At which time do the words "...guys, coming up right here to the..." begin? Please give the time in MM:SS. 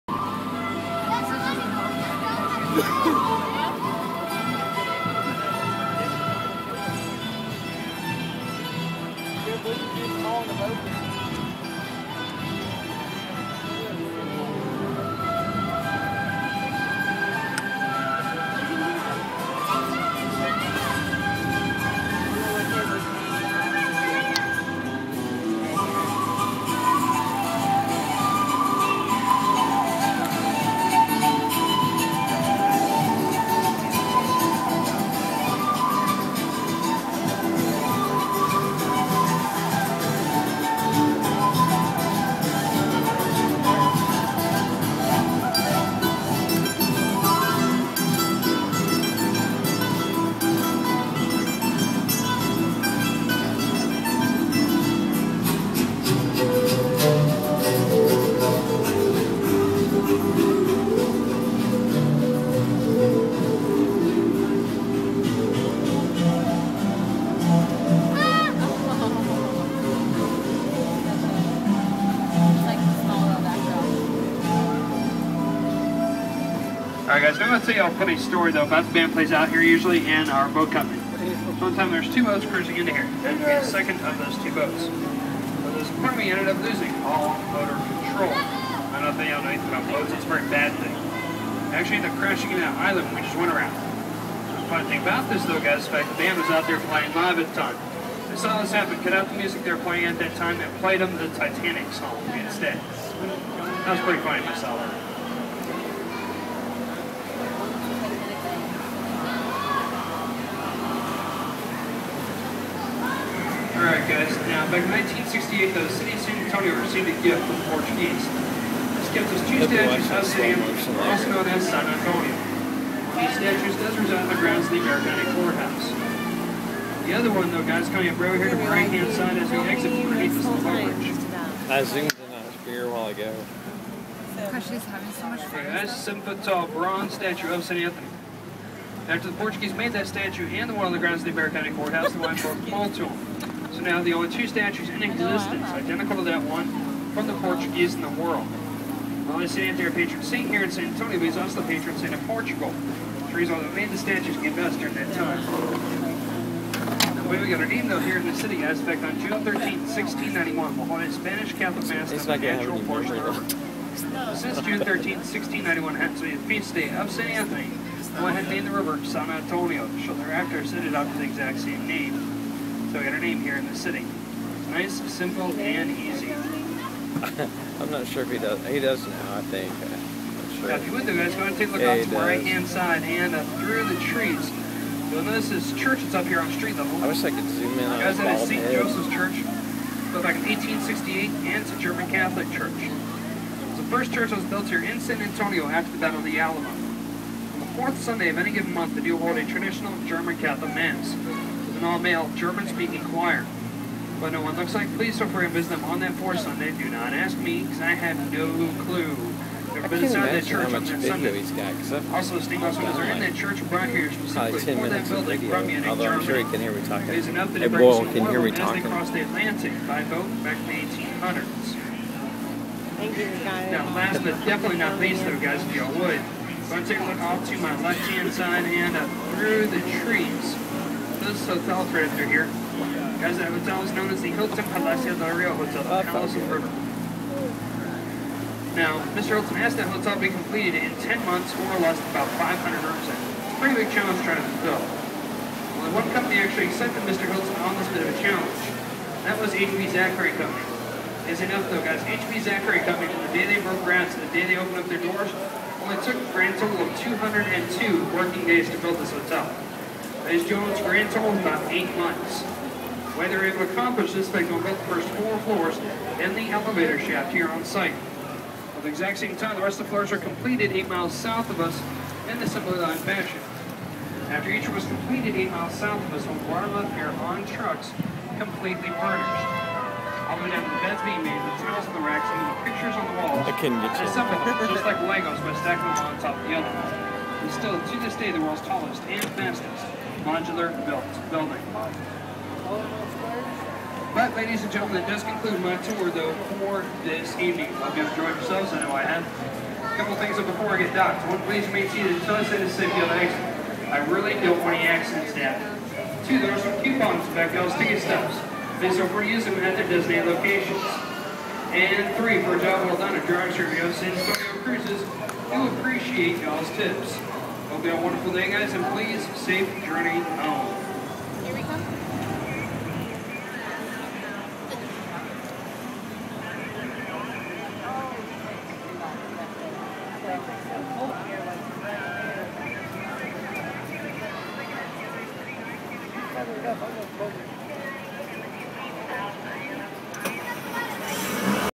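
02:07.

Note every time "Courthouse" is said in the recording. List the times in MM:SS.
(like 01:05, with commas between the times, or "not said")
02:05, 02:21.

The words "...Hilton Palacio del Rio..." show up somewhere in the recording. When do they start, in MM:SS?
03:54.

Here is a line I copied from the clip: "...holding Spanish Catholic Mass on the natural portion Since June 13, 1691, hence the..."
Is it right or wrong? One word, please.
right.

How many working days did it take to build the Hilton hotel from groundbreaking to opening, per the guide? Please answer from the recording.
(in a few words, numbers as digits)
202.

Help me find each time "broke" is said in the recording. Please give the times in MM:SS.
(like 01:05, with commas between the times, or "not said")
02:22, 04:13.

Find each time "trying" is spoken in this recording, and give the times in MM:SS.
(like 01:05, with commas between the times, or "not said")
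04:04.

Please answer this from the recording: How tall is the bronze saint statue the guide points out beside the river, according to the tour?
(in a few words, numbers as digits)
7 feet.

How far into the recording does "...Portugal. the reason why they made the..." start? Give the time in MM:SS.
02:32.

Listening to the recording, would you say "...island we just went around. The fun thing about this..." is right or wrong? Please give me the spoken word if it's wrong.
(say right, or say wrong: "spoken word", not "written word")
right.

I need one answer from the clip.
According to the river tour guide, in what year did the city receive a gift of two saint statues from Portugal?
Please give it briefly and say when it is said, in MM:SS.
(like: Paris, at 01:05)
1968, at 01:54.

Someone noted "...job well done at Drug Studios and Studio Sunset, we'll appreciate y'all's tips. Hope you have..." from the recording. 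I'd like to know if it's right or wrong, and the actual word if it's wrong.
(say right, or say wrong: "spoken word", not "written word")
wrong: "Cruises", not "Sunset".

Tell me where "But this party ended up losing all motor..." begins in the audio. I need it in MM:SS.
01:25.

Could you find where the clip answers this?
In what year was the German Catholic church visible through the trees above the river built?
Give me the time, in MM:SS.
03:10.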